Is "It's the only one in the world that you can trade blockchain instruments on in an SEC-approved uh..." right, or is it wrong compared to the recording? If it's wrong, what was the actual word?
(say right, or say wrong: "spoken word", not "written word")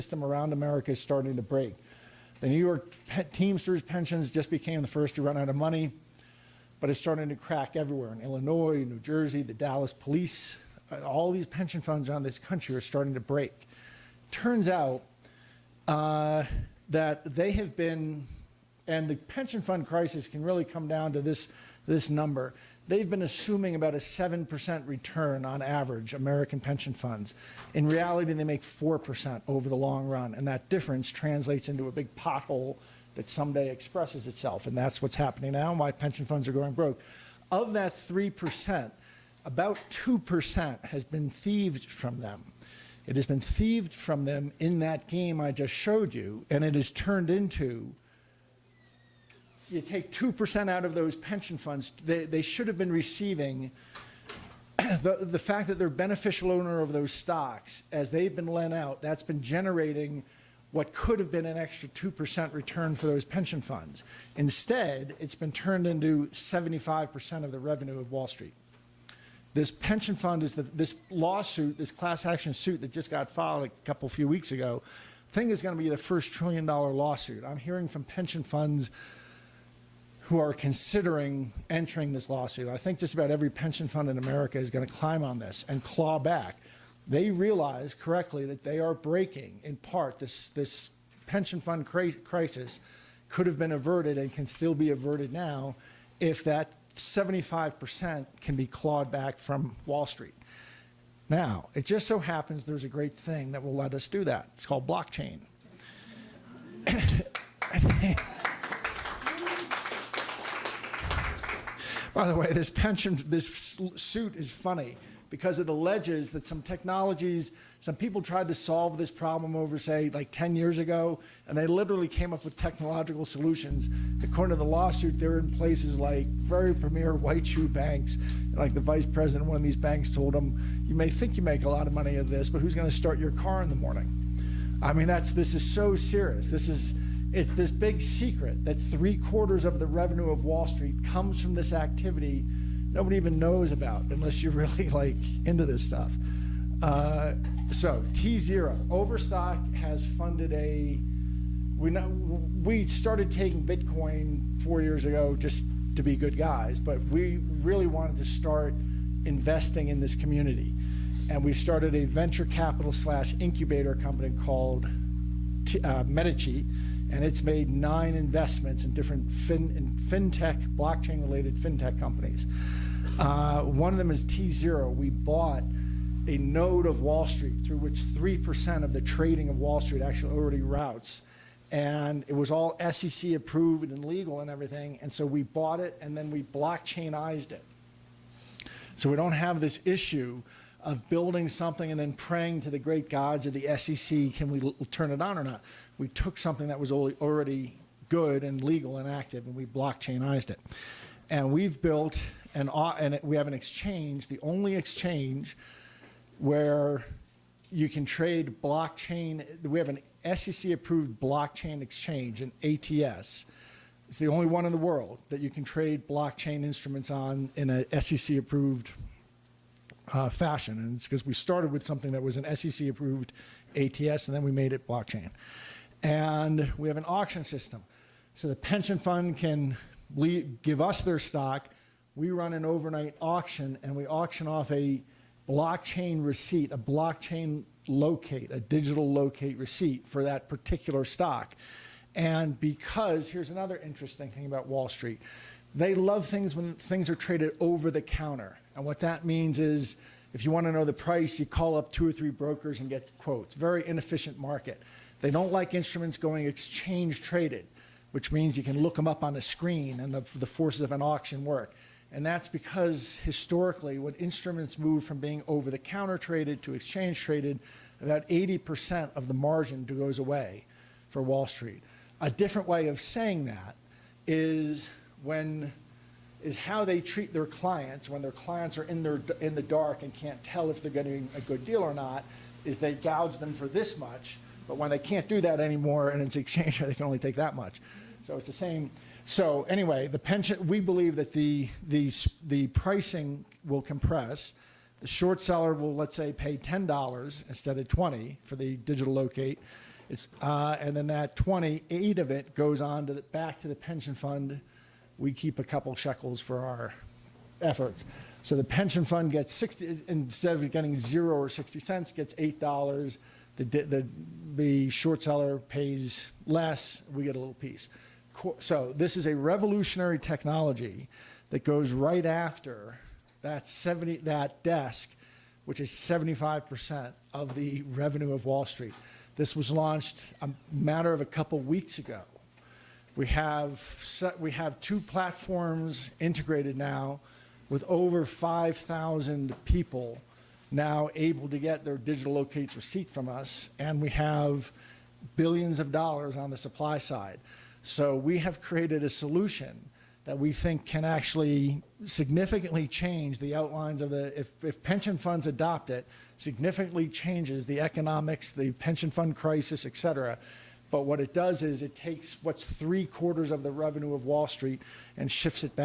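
right.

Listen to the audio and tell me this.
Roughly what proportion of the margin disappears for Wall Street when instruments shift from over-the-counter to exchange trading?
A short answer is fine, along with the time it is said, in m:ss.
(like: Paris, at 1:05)
80%, at 4:28.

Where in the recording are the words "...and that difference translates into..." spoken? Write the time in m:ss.
0:30.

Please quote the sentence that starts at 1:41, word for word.
Now, it just so happens there's a great thing that will let us do that.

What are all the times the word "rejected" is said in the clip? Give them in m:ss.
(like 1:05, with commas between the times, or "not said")
not said.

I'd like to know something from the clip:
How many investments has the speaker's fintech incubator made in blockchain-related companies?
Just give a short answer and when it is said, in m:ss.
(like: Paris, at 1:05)
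9, at 2:47.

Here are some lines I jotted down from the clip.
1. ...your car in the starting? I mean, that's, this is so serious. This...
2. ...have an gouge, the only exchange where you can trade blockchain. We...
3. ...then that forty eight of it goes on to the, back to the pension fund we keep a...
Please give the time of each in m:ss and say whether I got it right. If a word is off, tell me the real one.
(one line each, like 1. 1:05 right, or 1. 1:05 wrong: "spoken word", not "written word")
1. 2:13 wrong: "morning", not "starting"
2. 3:23 wrong: "exchange", not "gouge"
3. 5:00 wrong: "twenty", not "forty".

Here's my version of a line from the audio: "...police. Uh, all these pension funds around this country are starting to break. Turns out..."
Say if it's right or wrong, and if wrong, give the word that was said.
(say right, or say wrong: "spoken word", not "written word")
right.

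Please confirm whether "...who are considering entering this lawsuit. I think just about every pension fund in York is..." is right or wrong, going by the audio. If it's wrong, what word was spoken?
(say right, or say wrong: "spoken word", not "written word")
wrong: "America", not "York".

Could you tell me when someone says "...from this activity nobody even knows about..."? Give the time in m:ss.
2:21.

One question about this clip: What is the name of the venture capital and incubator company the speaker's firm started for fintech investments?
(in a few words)
Medici.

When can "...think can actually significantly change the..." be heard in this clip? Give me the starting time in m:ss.
5:50.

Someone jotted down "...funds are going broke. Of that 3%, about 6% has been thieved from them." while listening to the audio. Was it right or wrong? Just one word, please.
wrong.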